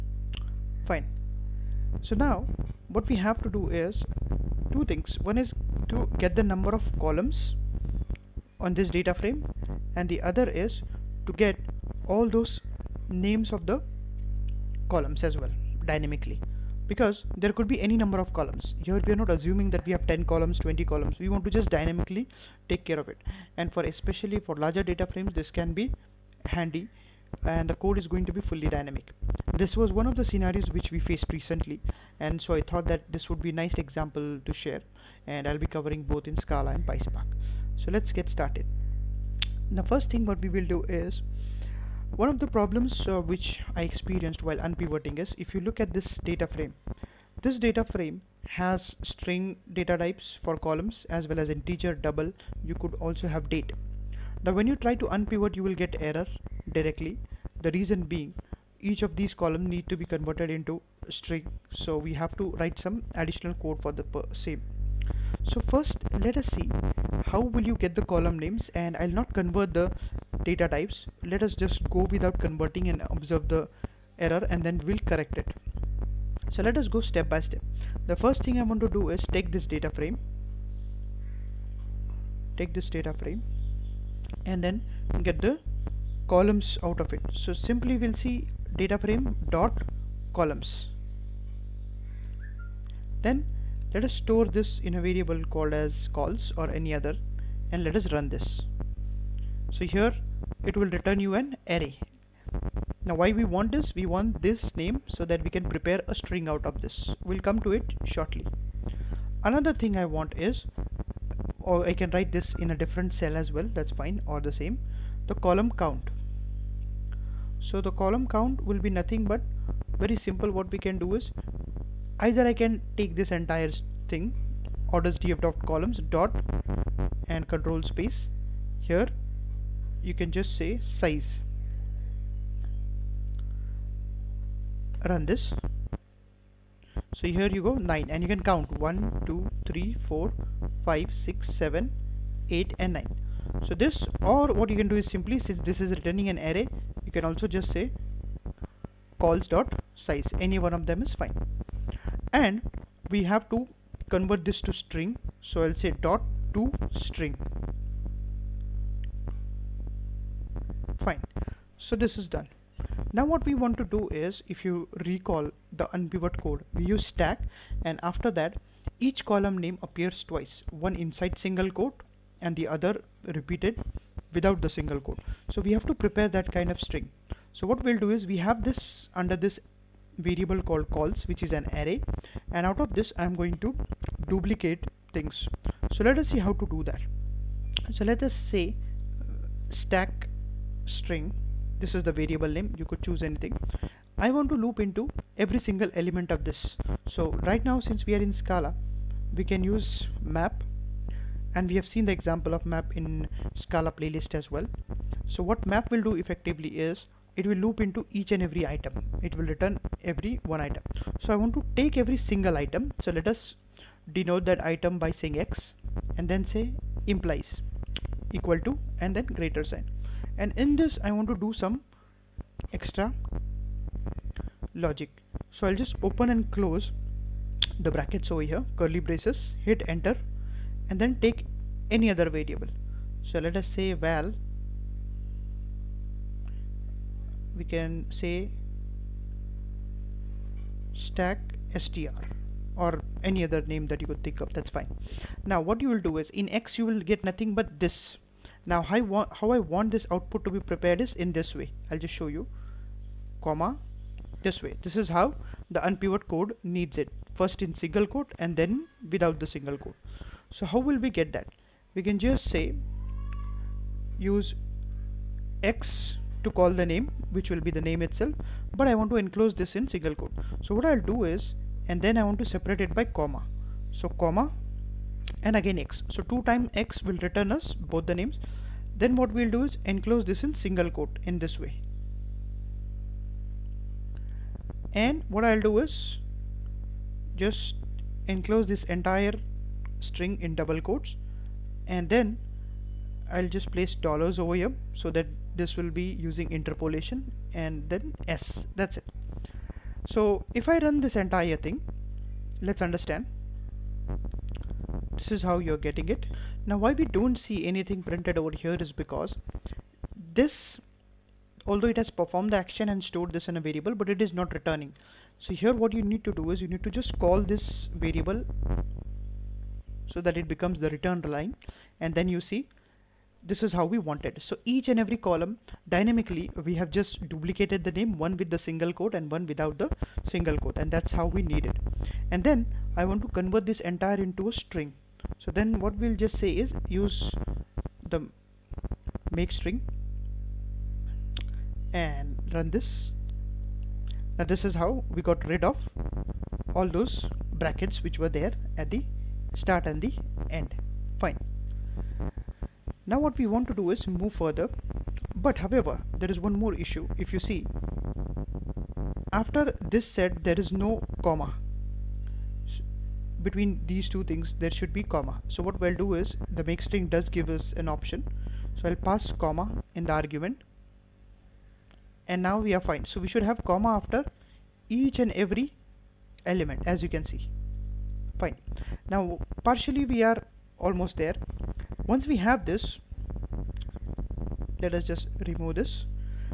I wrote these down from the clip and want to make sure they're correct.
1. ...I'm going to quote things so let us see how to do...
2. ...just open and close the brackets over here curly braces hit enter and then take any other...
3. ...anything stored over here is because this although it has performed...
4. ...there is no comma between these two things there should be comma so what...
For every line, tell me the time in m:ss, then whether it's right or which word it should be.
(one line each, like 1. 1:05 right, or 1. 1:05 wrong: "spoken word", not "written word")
1. 3:03 wrong: "duplicate", not "quote"
2. 3:45 right
3. 5:07 wrong: "printed", not "stored"
4. 6:00 right.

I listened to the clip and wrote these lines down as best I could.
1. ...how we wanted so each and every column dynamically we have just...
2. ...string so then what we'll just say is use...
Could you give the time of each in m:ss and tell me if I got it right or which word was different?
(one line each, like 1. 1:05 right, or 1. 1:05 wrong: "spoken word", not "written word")
1. 5:23 right
2. 5:34 right.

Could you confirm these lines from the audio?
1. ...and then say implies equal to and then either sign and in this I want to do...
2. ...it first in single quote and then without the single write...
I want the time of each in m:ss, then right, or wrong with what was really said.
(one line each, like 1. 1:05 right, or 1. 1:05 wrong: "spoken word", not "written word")
1. 3:36 wrong: "greater", not "either"
2. 4:16 wrong: "quote", not "write".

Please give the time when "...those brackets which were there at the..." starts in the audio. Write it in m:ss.
5:46.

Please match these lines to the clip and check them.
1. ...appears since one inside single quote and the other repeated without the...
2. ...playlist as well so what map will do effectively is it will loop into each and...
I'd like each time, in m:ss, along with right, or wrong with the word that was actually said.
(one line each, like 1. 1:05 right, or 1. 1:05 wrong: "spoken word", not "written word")
1. 2:49 wrong: "twice", not "since"
2. 3:23 right.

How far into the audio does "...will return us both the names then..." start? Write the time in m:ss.
4:37.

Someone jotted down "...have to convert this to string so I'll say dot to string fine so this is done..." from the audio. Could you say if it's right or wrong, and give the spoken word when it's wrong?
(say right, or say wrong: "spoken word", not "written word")
right.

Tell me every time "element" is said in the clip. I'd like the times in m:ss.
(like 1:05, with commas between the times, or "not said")
3:15, 6:16.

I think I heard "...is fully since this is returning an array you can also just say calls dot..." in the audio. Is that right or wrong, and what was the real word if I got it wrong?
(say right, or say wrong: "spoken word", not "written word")
wrong: "simply", not "fully".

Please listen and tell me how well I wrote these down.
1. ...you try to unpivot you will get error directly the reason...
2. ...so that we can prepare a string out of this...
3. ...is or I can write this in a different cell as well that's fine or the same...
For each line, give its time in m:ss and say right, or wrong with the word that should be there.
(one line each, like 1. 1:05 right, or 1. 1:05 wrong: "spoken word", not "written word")
1. 0:54 right
2. 1:45 right
3. 1:50 right.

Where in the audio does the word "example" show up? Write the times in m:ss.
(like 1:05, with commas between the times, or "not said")
0:33, 3:22.